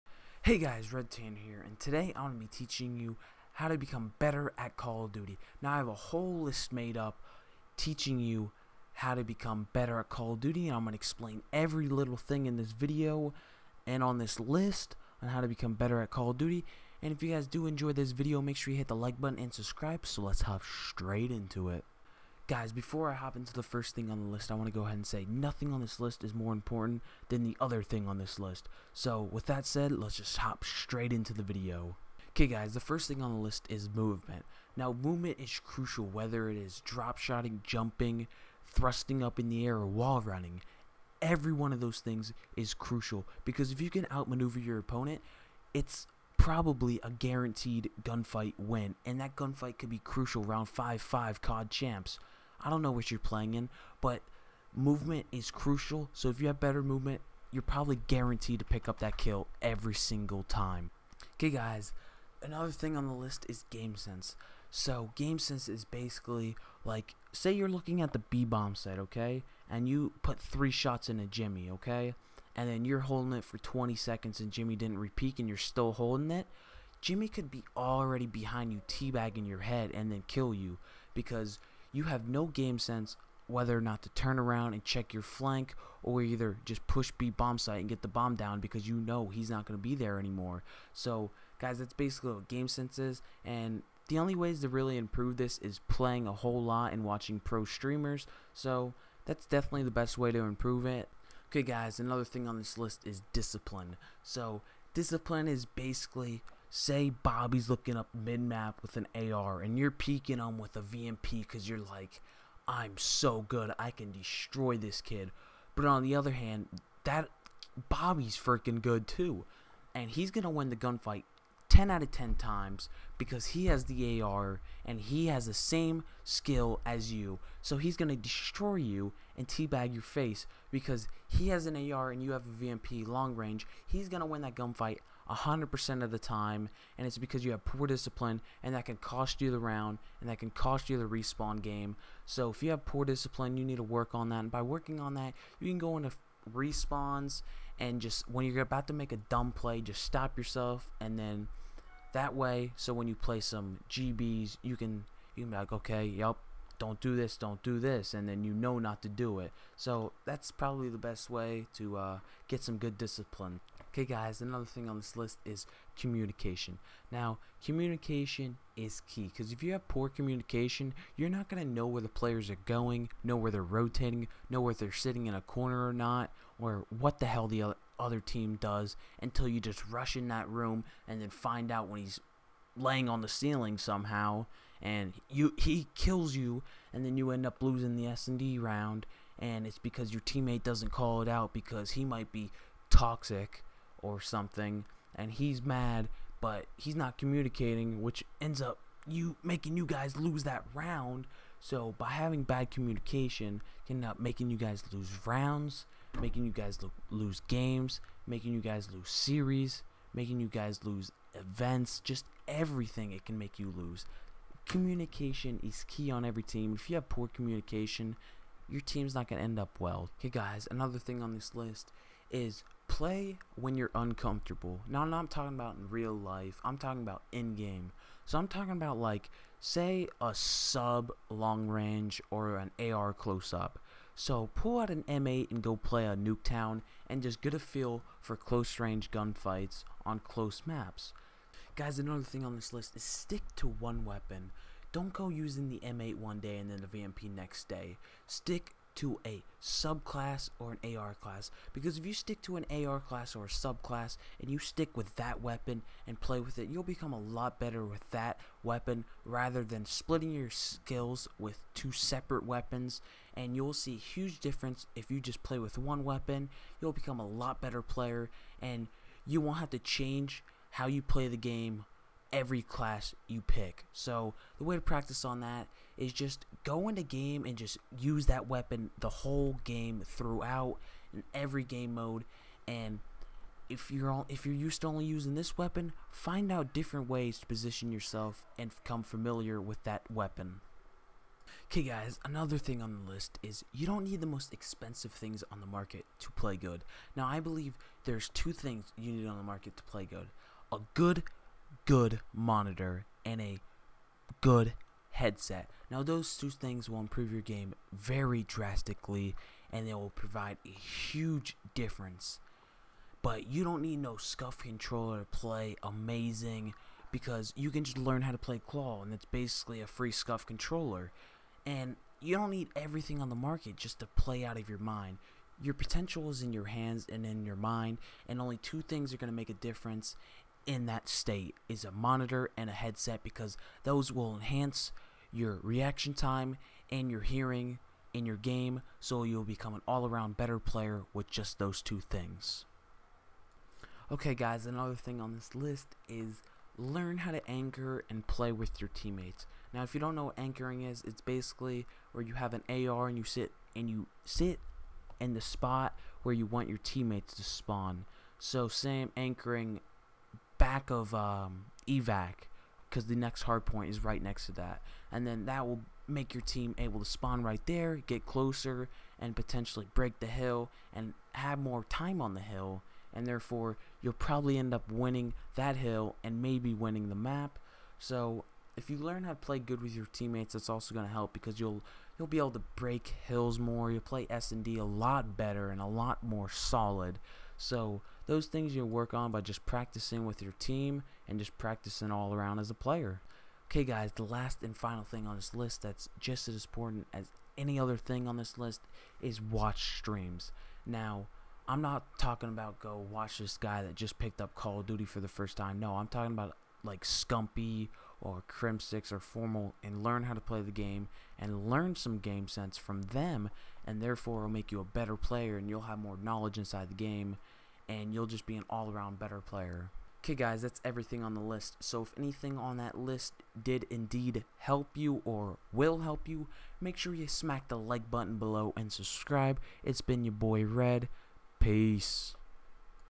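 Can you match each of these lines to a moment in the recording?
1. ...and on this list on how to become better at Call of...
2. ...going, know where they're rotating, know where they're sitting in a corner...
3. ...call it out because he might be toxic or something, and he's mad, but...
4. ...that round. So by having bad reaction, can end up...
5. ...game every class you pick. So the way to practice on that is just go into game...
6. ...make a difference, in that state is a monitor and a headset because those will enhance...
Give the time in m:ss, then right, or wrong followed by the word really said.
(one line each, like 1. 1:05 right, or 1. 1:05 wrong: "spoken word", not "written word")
1. 0:13 right
2. 2:52 right
3. 3:10 right
4. 3:20 wrong: "communication", not "reaction"
5. 4:31 right
6. 5:29 right.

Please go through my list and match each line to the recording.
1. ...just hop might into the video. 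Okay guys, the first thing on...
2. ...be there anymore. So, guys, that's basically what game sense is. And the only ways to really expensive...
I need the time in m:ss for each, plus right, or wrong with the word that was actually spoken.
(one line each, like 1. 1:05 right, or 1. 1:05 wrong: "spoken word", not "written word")
1. 0:30 wrong: "straight", not "might"
2. 1:29 wrong: "improve", not "expensive".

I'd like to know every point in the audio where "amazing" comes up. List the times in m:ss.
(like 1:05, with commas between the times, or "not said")
5:15.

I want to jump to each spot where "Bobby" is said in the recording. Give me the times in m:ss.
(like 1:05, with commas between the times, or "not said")
1:47, 1:57.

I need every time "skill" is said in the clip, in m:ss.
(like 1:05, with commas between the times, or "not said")
2:06, 4:20.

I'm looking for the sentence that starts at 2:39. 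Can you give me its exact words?
So that's probably the best way to uh, get some good discipline.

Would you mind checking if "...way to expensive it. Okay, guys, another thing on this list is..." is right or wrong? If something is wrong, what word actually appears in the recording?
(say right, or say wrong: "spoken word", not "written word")
wrong: "improve", not "expensive".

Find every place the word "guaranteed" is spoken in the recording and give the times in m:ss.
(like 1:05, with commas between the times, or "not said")
0:47, 0:58.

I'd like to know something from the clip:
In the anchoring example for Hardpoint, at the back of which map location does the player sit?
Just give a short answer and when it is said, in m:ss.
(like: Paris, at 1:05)
Evac, at 6:01.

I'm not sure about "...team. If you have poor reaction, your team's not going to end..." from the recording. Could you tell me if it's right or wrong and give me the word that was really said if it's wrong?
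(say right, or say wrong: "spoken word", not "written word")
wrong: "communication", not "reaction".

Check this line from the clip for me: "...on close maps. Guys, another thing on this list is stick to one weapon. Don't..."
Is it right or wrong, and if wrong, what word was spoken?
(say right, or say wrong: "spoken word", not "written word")
right.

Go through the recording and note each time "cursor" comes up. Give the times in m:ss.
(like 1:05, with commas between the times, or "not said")
not said.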